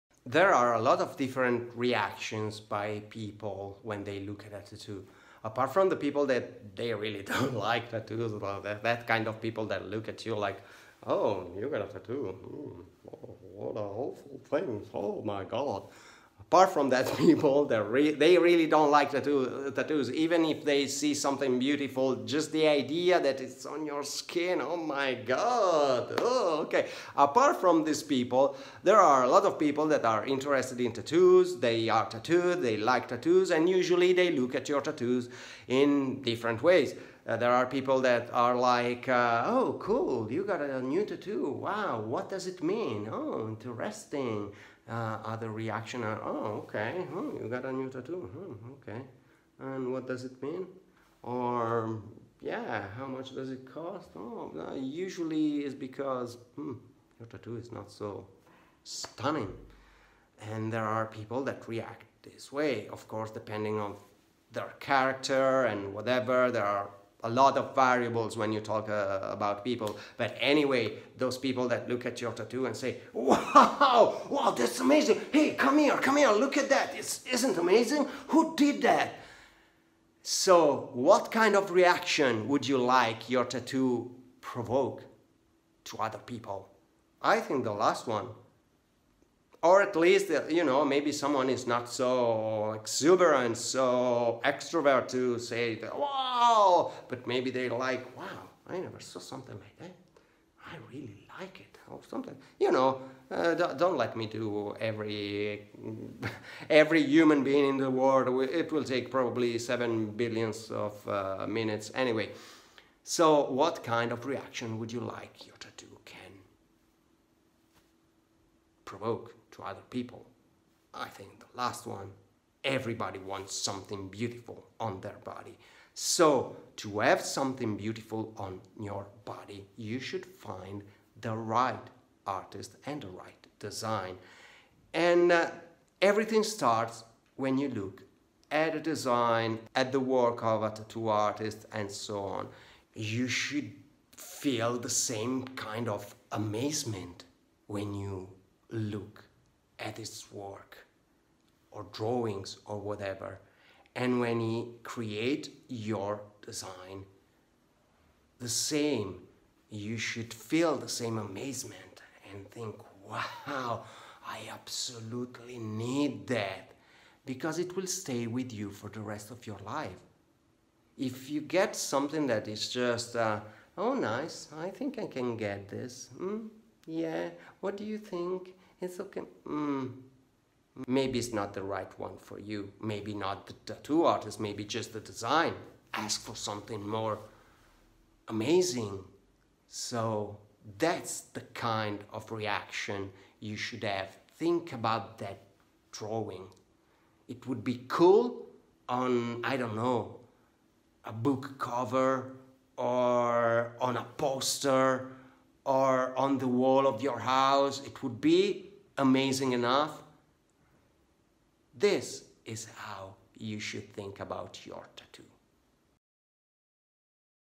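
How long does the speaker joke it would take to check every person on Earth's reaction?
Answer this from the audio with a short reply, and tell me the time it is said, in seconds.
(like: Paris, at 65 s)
7 billion, at 109 s.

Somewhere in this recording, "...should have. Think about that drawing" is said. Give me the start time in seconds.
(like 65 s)
193 s.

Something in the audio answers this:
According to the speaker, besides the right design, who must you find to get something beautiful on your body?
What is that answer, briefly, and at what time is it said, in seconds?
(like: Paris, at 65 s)
The right artist, at 131 s.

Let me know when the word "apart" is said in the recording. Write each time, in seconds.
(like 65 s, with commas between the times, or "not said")
5 s, 16 s, 27 s.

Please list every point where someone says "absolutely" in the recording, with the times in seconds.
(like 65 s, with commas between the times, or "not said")
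164 s.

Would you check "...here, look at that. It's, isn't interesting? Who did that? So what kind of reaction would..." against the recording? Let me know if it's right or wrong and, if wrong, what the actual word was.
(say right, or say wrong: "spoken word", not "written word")
wrong: "amazing", not "interesting".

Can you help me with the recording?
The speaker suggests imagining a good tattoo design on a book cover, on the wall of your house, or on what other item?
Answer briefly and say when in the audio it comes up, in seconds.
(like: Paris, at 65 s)
A poster, at 203 s.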